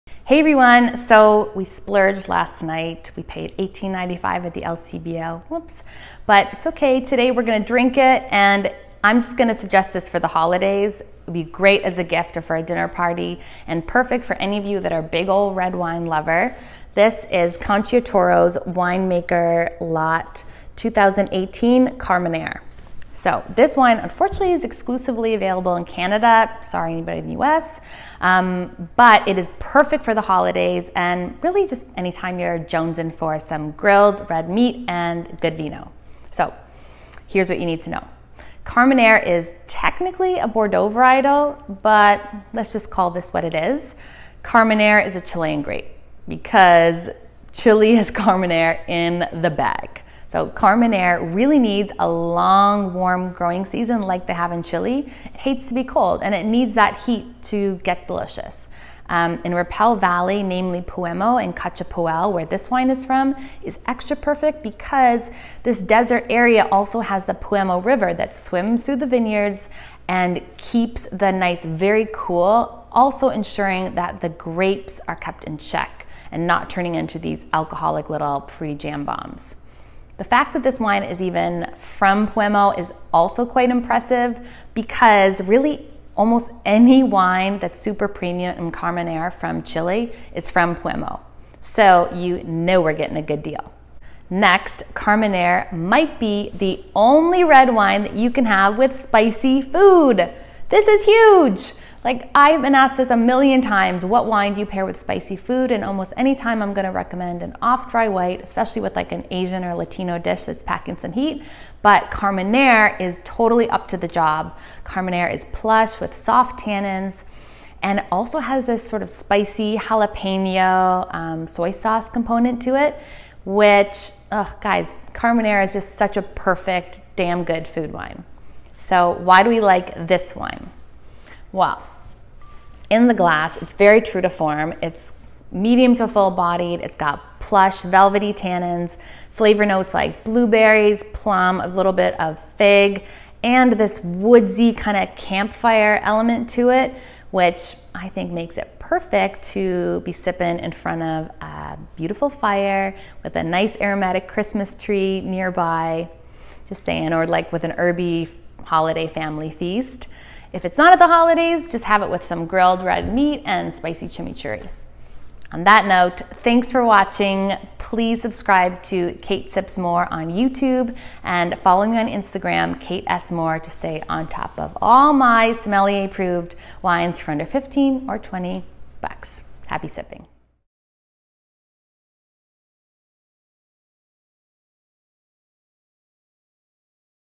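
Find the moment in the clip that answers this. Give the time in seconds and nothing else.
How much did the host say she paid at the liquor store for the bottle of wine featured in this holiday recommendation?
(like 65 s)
3 s.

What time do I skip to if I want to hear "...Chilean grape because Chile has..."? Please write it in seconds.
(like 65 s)
45 s.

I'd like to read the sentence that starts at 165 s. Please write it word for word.
On that note, thanks for watching.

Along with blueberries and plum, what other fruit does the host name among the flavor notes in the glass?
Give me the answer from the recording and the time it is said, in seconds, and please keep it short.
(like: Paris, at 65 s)
fig, at 142 s.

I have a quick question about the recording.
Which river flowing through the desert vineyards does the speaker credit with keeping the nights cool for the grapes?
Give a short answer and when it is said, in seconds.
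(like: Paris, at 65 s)
Peumo River, at 67 s.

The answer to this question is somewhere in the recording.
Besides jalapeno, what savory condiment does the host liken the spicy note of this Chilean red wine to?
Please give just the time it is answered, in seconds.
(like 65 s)
121 s.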